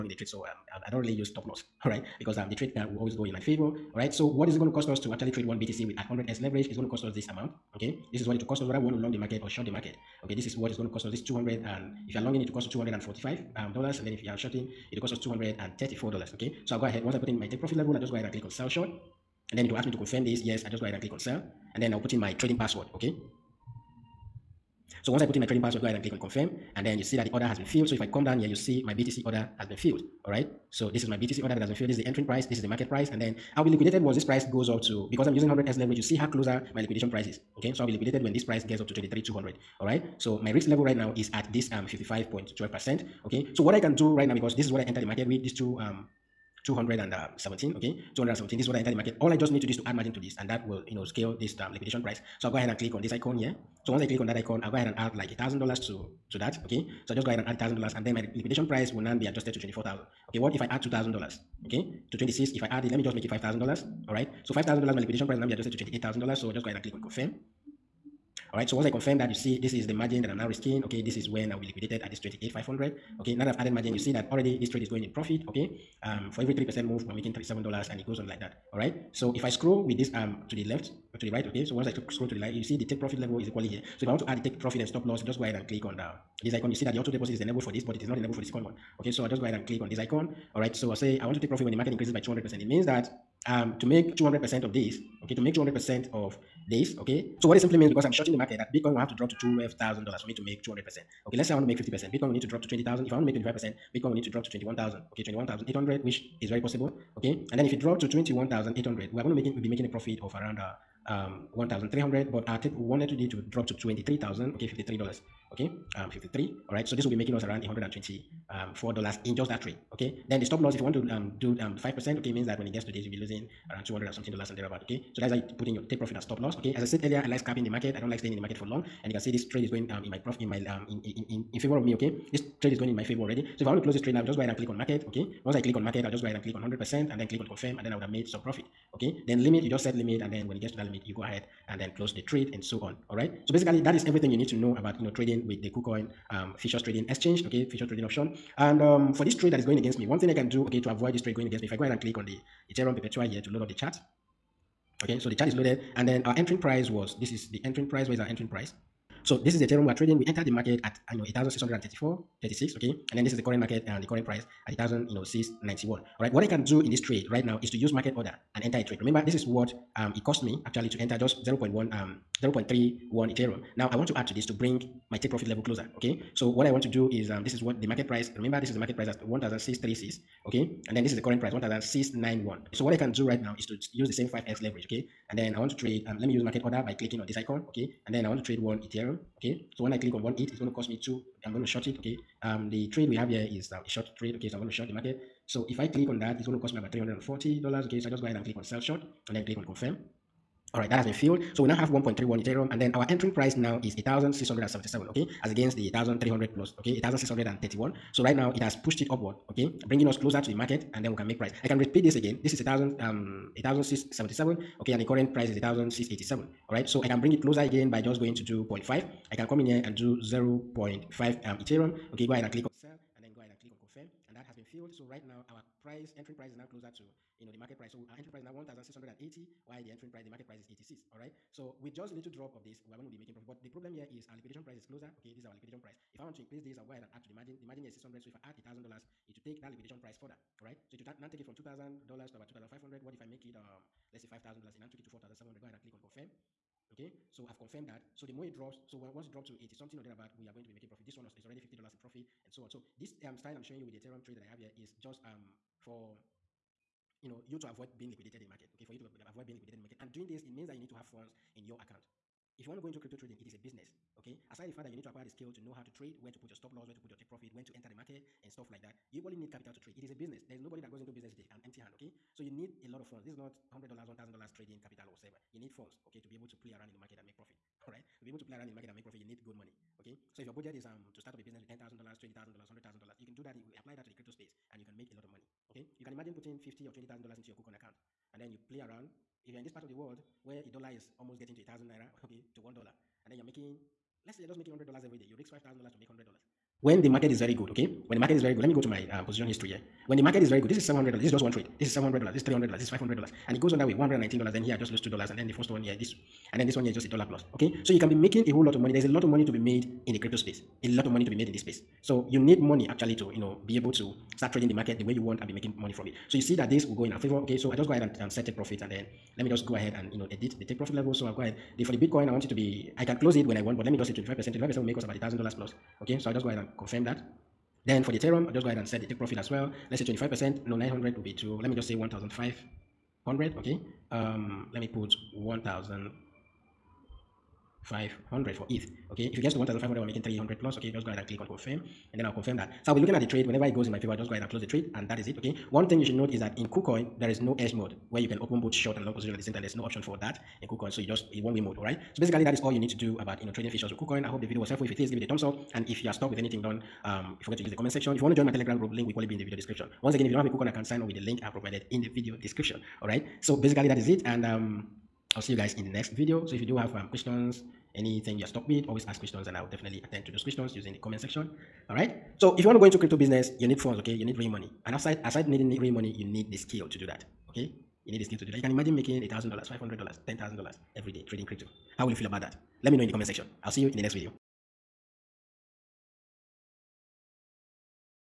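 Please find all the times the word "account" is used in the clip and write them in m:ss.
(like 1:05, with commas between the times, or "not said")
4:21, 4:47, 6:00.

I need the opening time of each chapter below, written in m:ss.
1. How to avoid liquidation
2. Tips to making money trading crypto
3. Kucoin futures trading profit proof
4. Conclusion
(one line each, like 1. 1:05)
1. 2:29
2. 4:22
3. 4:59
4. 5:45.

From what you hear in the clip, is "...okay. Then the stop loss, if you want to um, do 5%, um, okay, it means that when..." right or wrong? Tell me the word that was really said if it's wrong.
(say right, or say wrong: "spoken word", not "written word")
right.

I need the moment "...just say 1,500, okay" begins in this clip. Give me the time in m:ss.
5:31.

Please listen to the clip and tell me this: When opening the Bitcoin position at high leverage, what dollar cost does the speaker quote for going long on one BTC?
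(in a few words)
$245.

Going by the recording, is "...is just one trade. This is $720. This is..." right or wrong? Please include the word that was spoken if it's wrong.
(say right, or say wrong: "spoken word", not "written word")
wrong: "700", not "720".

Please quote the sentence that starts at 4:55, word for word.
You risk $5,000 to make $100.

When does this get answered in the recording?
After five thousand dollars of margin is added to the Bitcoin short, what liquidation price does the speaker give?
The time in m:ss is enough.
1:05.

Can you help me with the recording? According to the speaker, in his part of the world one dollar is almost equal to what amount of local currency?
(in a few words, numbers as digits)
1,000 naira.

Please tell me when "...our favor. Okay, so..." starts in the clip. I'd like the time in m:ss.
5:17.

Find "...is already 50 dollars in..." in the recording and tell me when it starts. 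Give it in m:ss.
4:11.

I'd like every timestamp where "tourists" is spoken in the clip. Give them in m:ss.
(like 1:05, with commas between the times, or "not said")
not said.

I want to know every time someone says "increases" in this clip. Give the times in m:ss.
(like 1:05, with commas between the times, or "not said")
1:31, 3:56.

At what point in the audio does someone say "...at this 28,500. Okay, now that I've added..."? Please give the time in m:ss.
1:12.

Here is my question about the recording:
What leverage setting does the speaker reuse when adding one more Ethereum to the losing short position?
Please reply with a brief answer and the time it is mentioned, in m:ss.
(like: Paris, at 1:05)
5x, at 3:04.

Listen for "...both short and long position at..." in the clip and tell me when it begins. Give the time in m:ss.
5:48.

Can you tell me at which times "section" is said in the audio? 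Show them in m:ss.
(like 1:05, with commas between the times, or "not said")
5:57, 6:11, 6:23.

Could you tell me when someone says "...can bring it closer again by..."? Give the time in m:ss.
3:37.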